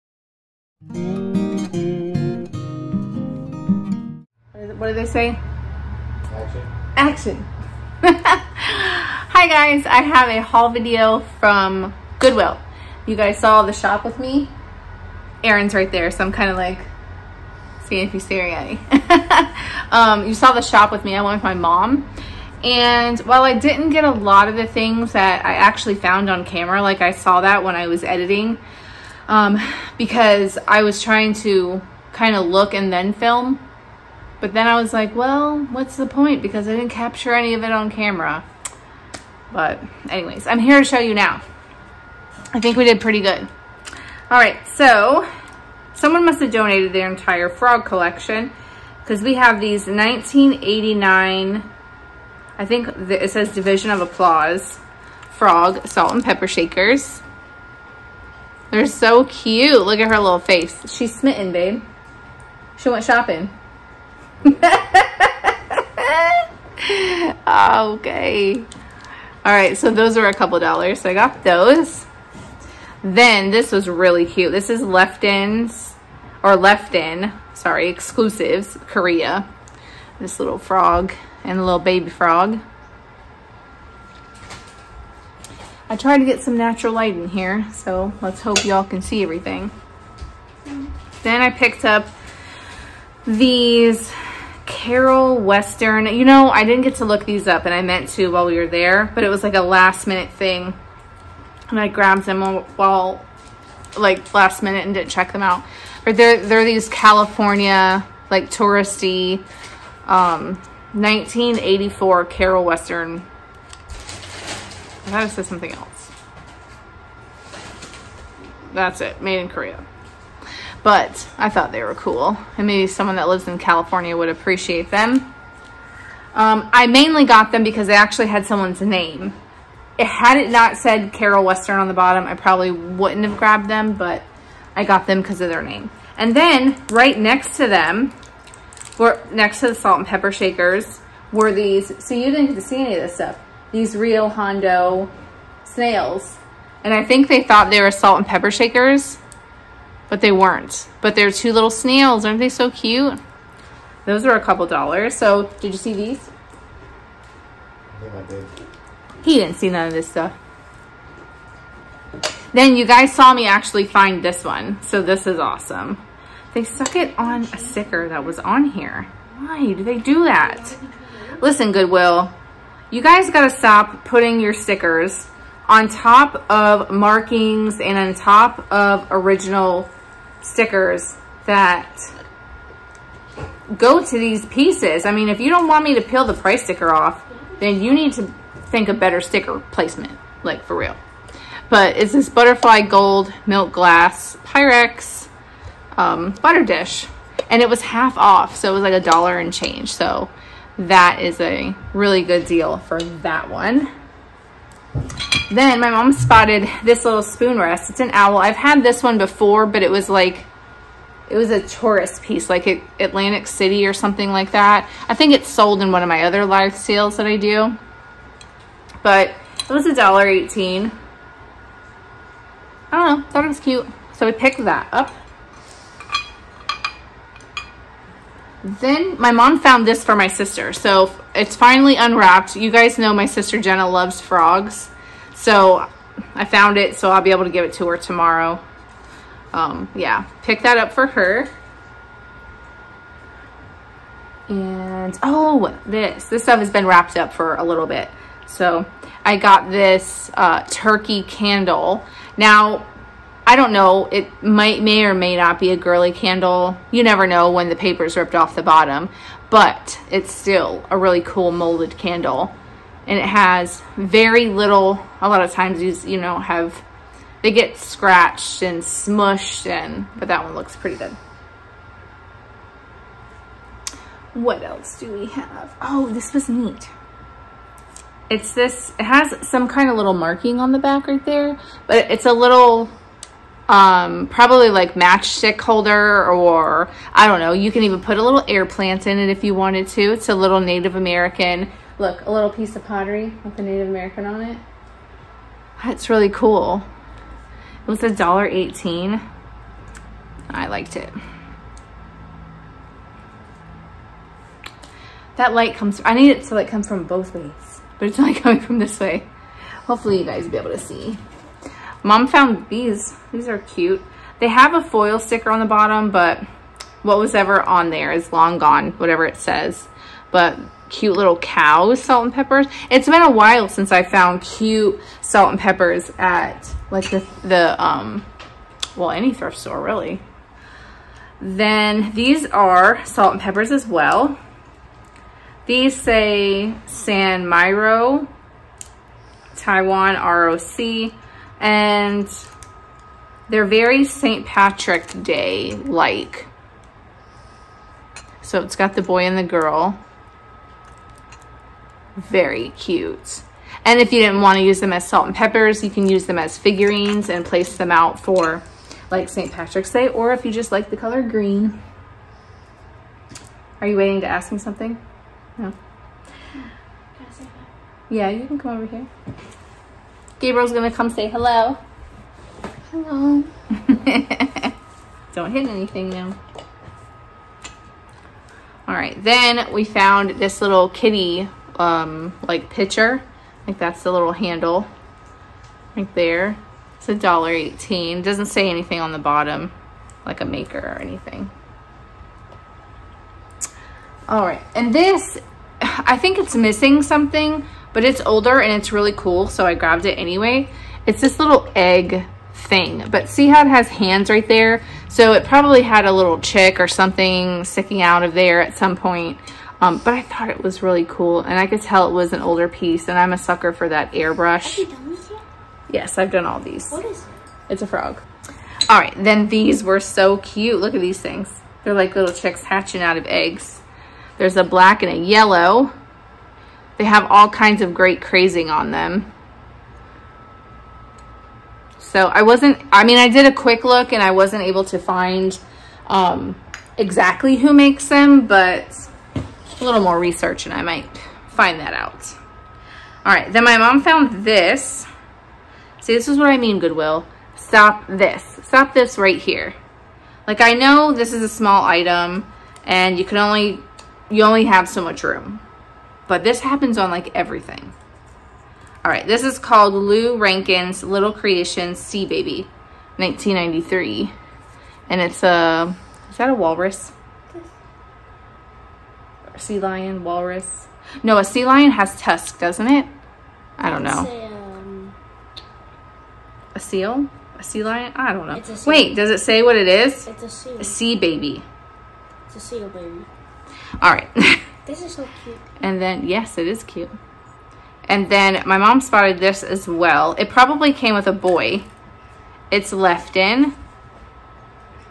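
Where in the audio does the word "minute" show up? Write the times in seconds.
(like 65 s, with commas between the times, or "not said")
100 s, 104 s.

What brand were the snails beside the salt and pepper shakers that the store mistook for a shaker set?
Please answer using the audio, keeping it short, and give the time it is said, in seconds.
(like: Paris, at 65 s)
Hondo, at 144 s.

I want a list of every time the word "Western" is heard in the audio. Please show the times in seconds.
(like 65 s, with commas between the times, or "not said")
95 s, 112 s, 131 s.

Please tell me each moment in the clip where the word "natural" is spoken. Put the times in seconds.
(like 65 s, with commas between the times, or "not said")
86 s.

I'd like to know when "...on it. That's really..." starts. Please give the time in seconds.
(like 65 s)
294 s.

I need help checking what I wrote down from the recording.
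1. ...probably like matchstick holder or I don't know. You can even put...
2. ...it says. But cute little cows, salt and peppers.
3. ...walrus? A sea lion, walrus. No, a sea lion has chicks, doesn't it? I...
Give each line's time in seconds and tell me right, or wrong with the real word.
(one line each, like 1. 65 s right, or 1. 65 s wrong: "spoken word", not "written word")
1. 284 s right
2. 319 s right
3. 466 s wrong: "tusks", not "chicks".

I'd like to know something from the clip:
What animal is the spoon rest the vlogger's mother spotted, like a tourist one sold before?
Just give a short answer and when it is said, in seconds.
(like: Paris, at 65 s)
owl, at 208 s.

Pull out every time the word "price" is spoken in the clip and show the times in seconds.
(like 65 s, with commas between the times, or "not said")
186 s.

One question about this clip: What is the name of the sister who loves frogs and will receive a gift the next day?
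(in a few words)
Jenna.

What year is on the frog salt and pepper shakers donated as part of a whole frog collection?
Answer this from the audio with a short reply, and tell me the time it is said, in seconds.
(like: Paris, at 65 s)
1989, at 49 s.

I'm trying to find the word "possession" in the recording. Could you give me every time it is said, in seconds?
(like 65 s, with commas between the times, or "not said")
not said.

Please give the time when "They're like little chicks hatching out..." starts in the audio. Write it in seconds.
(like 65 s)
421 s.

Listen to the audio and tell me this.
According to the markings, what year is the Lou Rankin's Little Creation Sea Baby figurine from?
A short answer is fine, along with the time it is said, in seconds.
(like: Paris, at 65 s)
1993, at 463 s.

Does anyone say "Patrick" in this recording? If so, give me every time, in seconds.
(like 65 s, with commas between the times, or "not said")
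344 s, 359 s.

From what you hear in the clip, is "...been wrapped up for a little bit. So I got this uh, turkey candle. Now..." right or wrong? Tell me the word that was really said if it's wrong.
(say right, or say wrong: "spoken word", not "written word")
right.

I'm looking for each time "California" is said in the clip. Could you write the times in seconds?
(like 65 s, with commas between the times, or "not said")
106 s, 123 s.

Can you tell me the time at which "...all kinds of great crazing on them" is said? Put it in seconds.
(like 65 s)
427 s.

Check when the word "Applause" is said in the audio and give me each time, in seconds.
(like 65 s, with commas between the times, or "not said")
54 s.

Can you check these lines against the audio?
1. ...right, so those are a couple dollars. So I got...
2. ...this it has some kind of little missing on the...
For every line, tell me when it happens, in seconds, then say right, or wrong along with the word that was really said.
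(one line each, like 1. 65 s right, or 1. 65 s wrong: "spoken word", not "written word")
1. 69 s right
2. 278 s wrong: "marking", not "missing".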